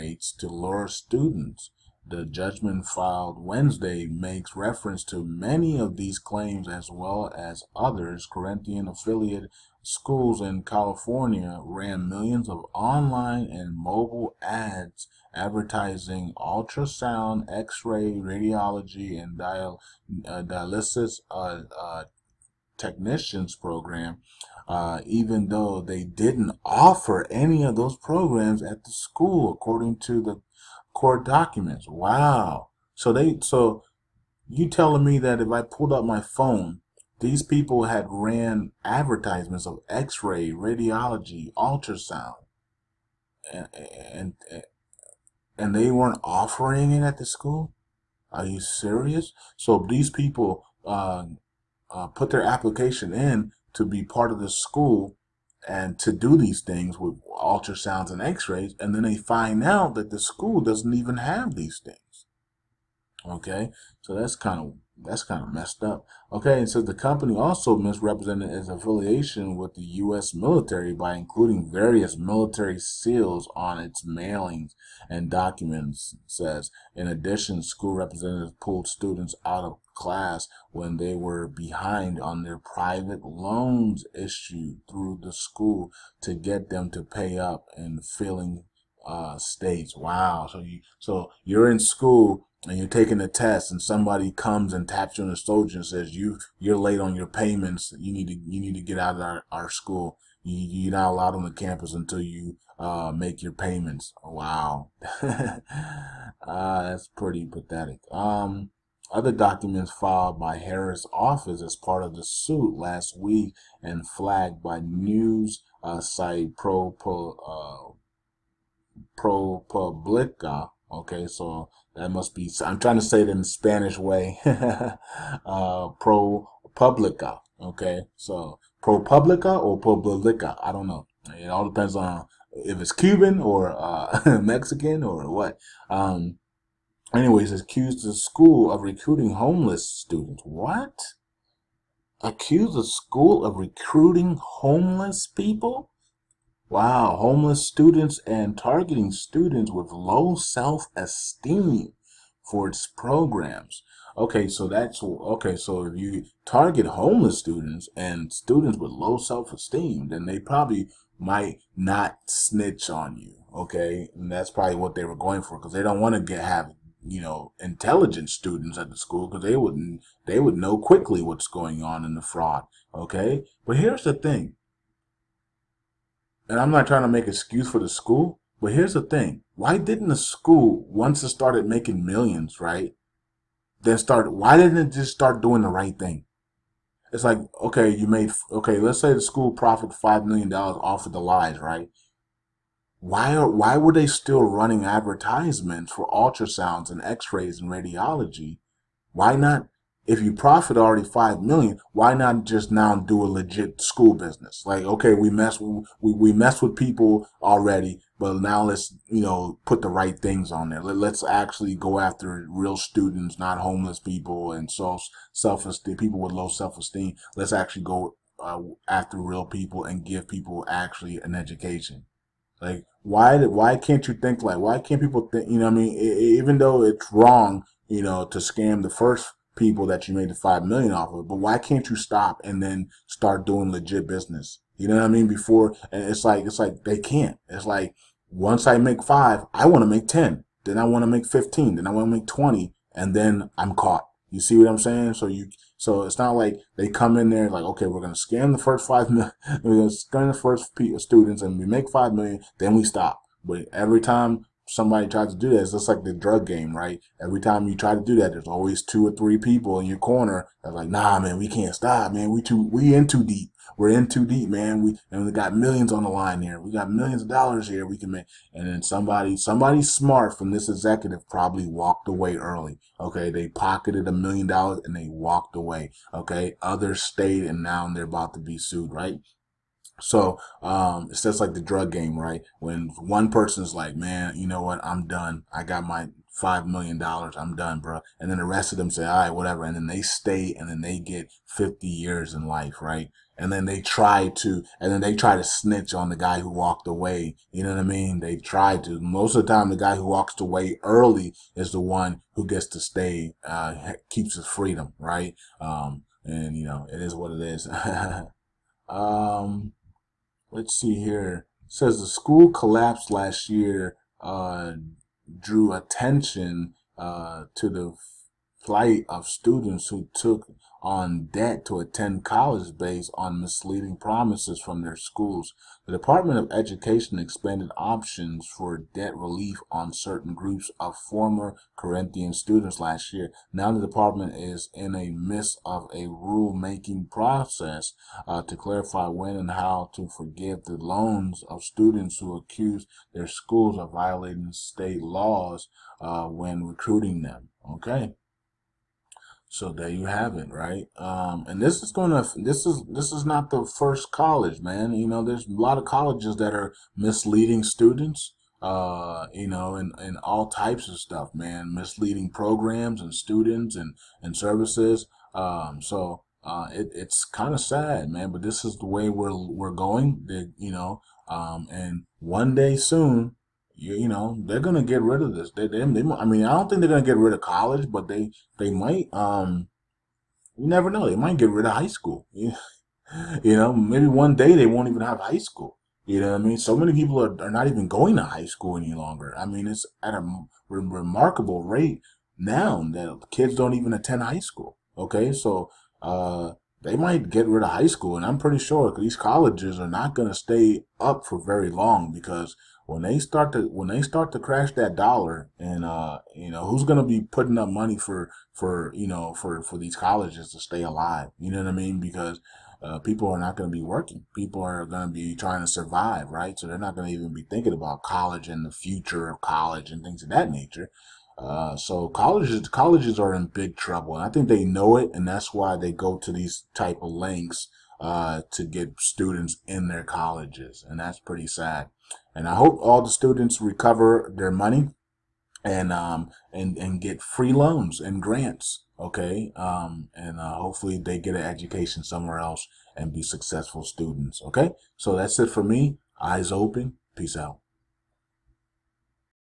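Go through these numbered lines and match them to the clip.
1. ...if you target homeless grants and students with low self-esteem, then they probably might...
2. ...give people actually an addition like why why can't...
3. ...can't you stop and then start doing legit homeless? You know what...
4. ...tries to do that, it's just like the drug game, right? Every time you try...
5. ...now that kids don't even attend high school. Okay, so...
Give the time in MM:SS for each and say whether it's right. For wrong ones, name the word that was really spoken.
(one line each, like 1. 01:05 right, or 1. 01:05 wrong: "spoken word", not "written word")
1. 02:35 wrong: "students", not "grants"
2. 03:40 wrong: "education", not "addition"
3. 03:51 wrong: "business", not "homeless"
4. 04:15 right
5. 06:32 right.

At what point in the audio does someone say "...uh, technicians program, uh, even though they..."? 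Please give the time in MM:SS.
00:21.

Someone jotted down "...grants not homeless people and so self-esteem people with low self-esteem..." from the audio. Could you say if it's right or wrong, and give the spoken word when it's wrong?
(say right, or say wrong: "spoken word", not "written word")
wrong: "students", not "grants".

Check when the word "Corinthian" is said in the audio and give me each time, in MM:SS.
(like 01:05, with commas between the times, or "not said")
00:08, 05:31.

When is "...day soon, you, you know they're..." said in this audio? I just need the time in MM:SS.
06:12.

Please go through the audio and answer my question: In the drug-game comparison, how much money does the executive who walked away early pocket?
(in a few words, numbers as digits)
A million dollars.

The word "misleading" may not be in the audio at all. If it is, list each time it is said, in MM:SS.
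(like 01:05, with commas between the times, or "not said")
05:23, 05:56, 06:01.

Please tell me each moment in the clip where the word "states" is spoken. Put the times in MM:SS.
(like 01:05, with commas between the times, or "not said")
01:29, 05:44.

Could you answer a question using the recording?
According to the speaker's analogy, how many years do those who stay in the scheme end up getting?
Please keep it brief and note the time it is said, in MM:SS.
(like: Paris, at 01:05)
50 years, at 04:51.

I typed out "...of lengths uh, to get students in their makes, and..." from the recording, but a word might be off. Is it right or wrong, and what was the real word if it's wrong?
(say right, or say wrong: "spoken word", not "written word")
wrong: "colleges", not "makes".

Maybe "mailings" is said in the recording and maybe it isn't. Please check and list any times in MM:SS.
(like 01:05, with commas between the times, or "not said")
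01:14.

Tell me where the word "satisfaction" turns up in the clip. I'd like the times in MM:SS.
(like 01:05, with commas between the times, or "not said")
not said.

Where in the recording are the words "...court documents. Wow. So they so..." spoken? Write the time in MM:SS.
00:30.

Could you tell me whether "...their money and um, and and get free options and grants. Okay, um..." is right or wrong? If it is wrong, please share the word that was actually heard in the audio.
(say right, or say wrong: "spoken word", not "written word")
wrong: "loans", not "options".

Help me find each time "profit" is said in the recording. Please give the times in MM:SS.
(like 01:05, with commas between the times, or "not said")
03:09, 03:20.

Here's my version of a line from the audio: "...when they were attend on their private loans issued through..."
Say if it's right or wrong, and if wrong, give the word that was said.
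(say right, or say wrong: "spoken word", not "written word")
wrong: "behind", not "attend".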